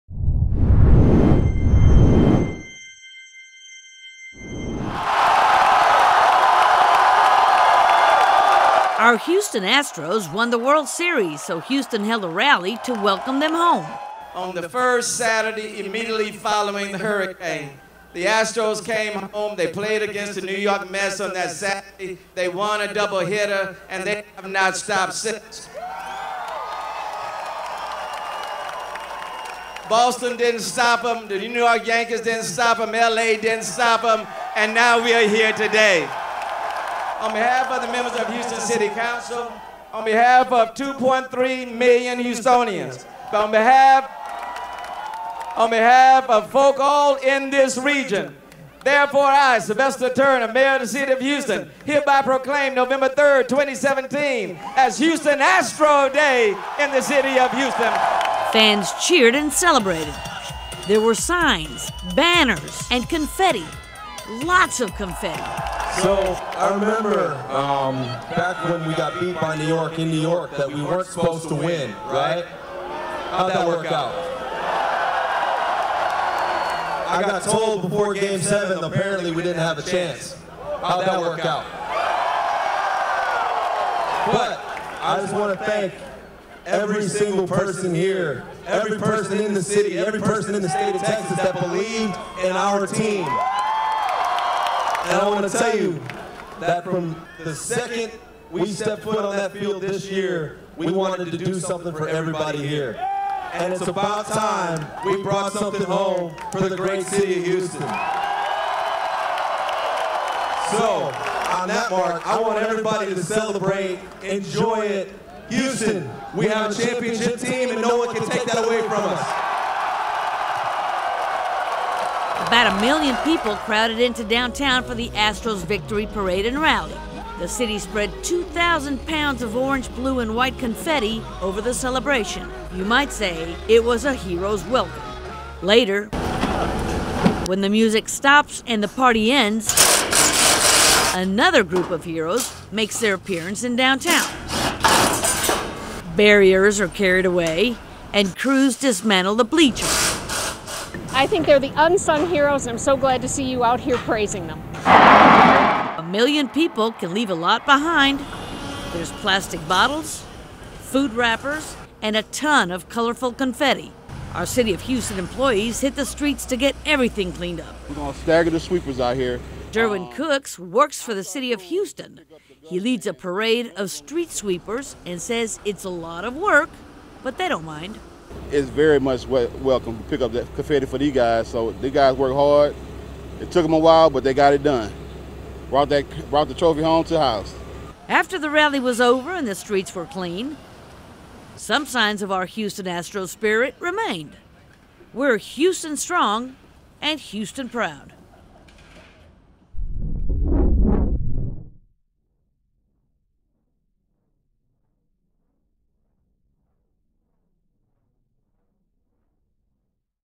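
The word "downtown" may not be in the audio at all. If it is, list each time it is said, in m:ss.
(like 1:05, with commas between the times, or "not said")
2:04, 2:23.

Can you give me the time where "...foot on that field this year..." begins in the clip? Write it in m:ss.
1:39.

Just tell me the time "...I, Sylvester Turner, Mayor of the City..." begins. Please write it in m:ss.
0:49.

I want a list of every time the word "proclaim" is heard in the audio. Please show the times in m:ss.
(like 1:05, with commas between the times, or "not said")
0:52.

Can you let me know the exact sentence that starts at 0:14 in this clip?
On the first Saturday immediately following the hurricane, the Astros came home.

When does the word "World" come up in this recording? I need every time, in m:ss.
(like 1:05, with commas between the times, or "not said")
0:10.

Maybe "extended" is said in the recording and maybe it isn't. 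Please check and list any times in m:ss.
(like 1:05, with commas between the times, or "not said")
not said.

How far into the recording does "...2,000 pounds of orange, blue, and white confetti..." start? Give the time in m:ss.
2:08.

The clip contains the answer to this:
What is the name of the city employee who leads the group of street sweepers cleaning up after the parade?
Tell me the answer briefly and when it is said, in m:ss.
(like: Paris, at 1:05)
Derwin Cooks, at 2:49.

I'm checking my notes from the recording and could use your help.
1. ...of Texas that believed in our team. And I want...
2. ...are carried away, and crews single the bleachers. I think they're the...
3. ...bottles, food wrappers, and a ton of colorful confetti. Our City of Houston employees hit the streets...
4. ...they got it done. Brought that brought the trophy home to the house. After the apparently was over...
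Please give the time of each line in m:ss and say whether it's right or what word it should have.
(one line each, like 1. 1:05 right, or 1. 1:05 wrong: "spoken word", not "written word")
1. 1:30 right
2. 2:26 wrong: "dismantle", not "single"
3. 2:39 right
4. 3:04 wrong: "rally", not "apparently".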